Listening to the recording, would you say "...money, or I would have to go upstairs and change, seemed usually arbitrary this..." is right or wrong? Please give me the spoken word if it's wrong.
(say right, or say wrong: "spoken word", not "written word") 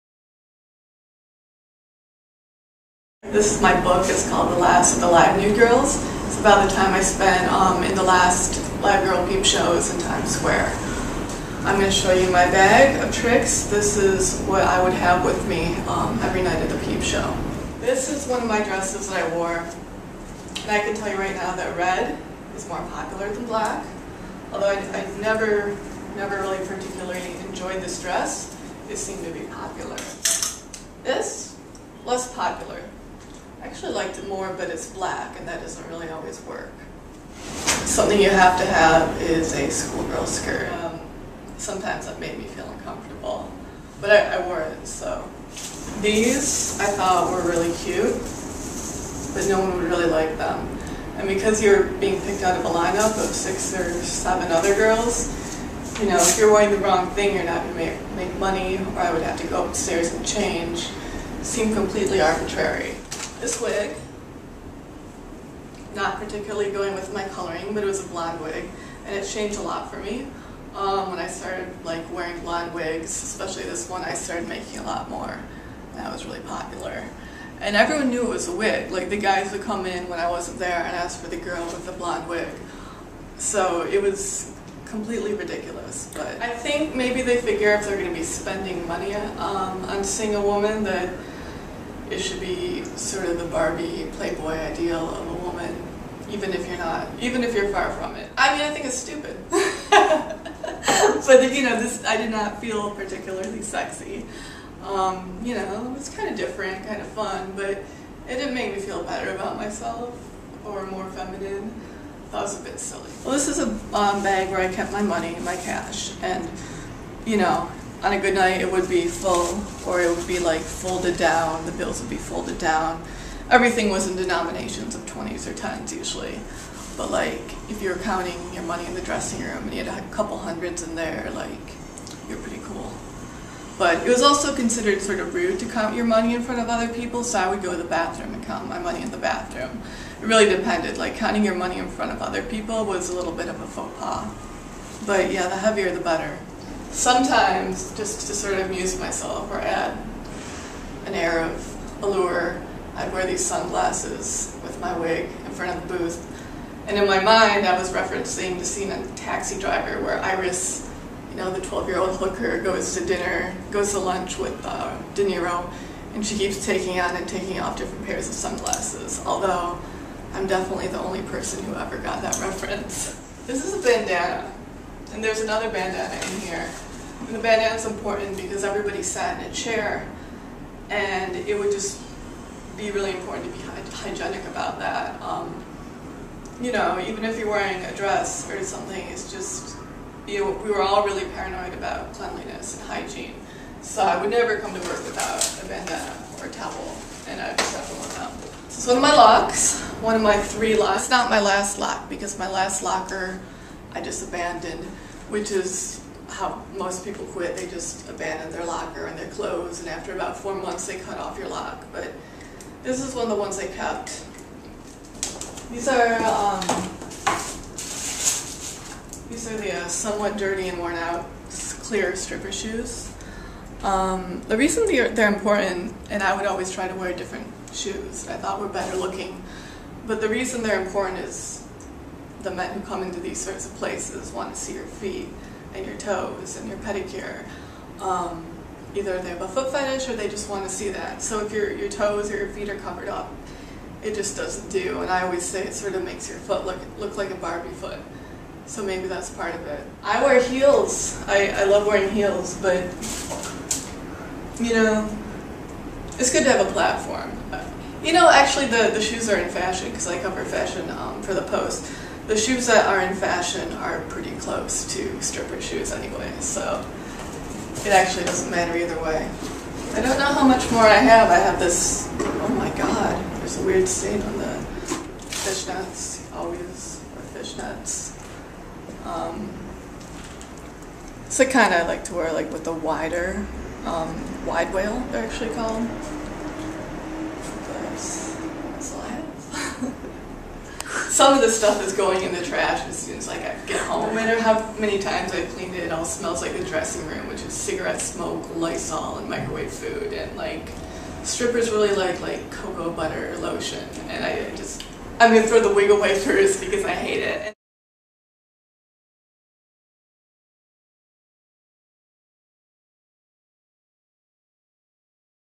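wrong: "completely", not "usually".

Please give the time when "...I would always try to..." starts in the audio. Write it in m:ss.
3:46.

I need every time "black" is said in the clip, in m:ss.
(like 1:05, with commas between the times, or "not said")
0:23, 0:34.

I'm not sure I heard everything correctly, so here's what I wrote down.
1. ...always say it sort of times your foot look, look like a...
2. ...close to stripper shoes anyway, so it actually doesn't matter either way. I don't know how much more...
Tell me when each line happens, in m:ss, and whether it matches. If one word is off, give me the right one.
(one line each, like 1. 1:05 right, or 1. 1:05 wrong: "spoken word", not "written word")
1. 4:05 wrong: "makes", not "times"
2. 4:24 right.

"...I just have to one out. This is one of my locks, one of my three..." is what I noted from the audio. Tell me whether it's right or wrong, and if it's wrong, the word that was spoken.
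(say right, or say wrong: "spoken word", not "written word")
right.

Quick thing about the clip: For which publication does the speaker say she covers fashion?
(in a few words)
The Post.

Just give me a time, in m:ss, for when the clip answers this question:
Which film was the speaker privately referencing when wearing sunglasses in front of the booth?
2:39.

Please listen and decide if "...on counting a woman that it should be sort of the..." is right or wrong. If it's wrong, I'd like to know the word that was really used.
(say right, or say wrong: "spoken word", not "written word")
wrong: "seeing", not "counting".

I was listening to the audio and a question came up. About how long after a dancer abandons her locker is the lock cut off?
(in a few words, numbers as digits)
4 months.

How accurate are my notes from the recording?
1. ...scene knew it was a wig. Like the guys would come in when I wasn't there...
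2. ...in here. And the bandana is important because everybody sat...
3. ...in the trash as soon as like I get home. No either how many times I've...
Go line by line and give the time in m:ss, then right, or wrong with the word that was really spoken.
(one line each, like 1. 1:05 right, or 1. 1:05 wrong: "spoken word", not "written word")
1. 1:17 wrong: "everyone", not "scene"
2. 2:56 right
3. 4:52 wrong: "matter", not "either".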